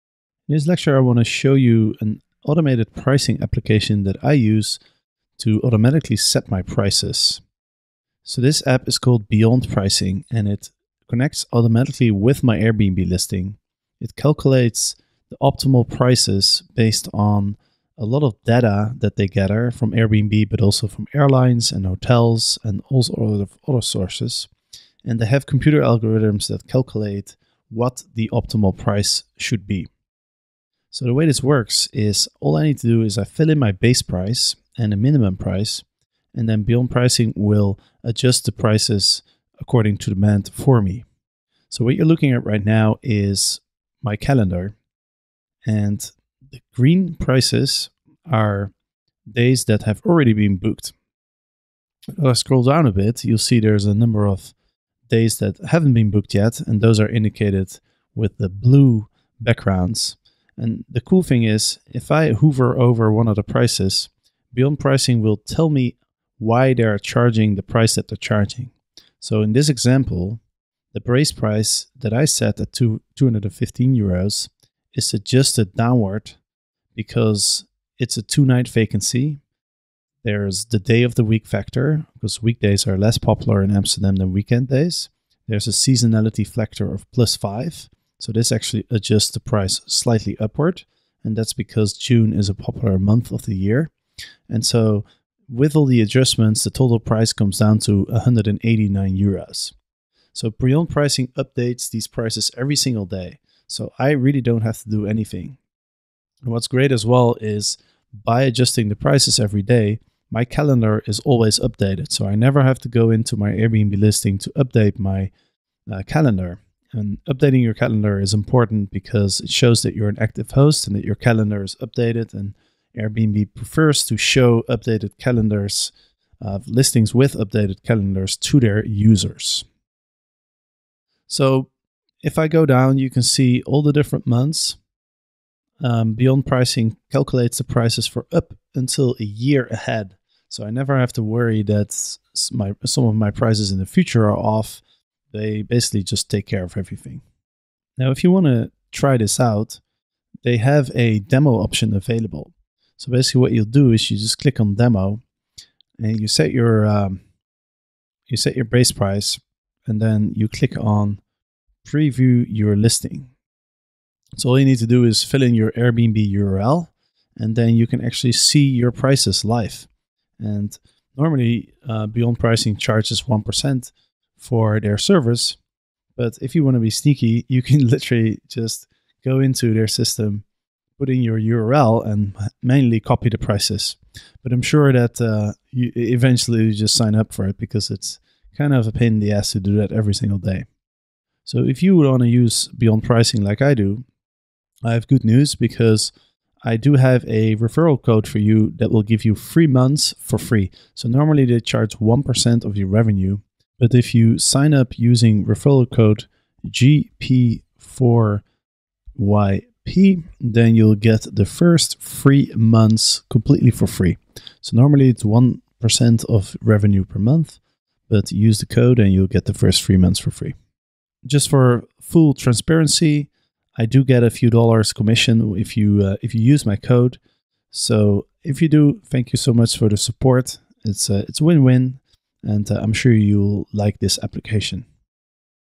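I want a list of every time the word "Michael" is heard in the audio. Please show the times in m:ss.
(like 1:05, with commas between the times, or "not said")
not said.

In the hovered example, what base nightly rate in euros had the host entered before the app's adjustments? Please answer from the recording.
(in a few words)
215 euros.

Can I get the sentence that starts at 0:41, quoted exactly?
So what you're looking at right now is my calendar, and the green prices are days that have already been booked.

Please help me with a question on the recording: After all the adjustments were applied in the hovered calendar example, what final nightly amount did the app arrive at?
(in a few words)
189 euros.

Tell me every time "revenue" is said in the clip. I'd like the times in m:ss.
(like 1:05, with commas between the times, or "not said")
3:22, 3:36.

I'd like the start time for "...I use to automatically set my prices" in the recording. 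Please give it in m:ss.
0:04.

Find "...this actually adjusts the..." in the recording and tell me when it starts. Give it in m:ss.
1:28.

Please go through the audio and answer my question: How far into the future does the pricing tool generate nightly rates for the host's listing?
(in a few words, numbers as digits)
a year.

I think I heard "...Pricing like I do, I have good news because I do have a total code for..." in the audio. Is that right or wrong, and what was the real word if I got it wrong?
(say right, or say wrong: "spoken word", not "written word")
wrong: "referral", not "total".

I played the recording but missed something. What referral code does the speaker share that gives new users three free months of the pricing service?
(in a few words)
GP4YP.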